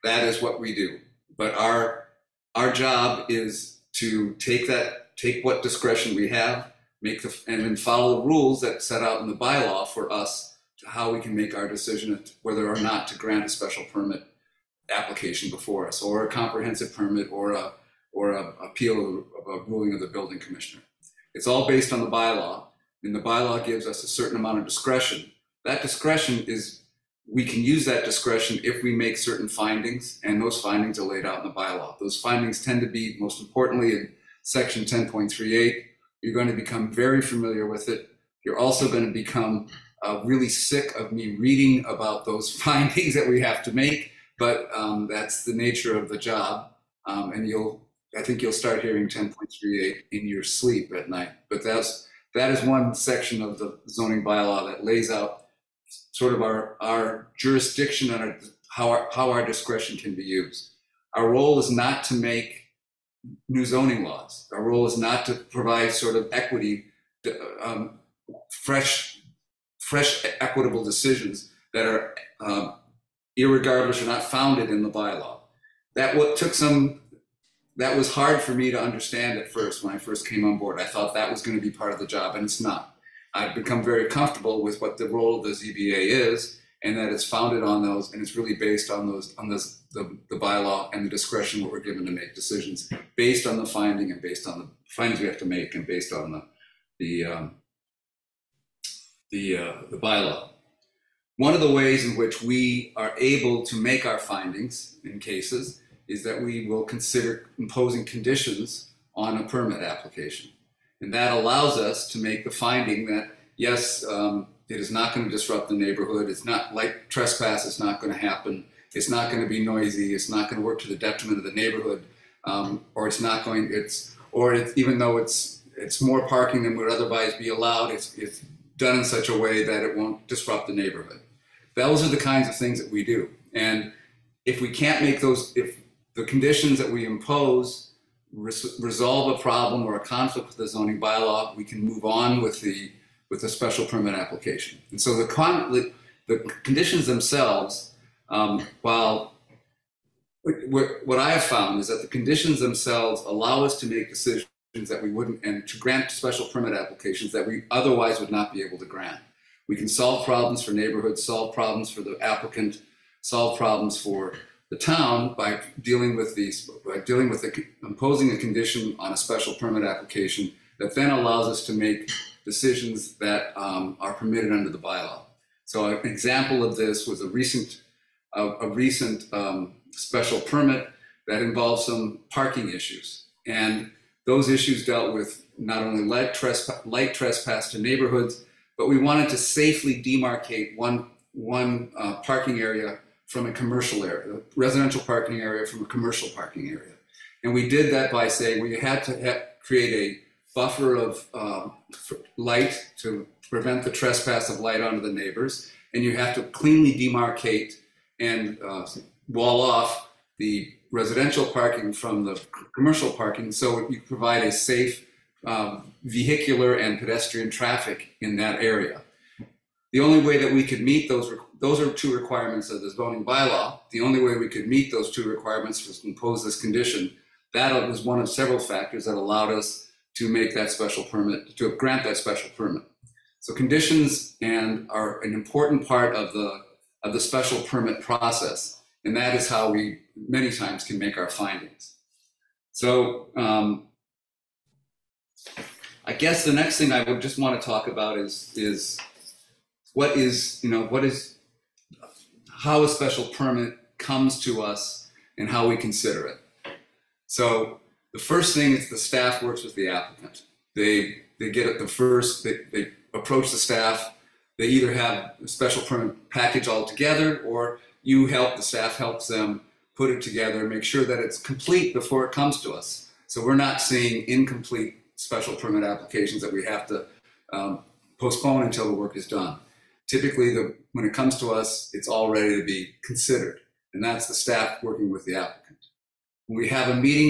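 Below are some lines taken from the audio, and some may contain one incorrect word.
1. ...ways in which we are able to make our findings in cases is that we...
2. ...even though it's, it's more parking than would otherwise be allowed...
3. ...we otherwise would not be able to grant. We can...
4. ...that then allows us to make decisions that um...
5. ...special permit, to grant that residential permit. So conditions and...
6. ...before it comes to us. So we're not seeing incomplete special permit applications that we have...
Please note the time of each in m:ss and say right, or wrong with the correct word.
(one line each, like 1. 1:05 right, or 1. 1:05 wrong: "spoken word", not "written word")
1. 1:41 right
2. 2:04 right
3. 2:37 right
4. 2:50 right
5. 3:50 wrong: "special", not "residential"
6. 4:31 right.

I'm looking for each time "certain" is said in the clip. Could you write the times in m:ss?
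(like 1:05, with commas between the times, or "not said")
0:24, 0:29.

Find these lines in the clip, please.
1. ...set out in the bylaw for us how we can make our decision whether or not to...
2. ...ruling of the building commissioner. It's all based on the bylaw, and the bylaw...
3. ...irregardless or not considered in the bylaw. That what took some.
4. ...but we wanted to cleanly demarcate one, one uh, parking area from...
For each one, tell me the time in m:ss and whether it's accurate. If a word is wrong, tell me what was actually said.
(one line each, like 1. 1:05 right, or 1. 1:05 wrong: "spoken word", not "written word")
1. 0:08 right
2. 0:19 right
3. 1:13 wrong: "founded", not "considered"
4. 3:08 wrong: "safely", not "cleanly".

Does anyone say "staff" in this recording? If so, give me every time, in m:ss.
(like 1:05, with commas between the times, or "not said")
4:18, 4:23, 4:28, 4:44.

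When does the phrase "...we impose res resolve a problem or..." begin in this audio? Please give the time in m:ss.
2:16.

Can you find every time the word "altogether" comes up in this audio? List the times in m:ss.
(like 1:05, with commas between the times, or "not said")
4:26.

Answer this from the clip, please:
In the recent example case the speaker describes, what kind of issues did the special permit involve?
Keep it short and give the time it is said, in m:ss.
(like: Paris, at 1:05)
parking issues, at 3:02.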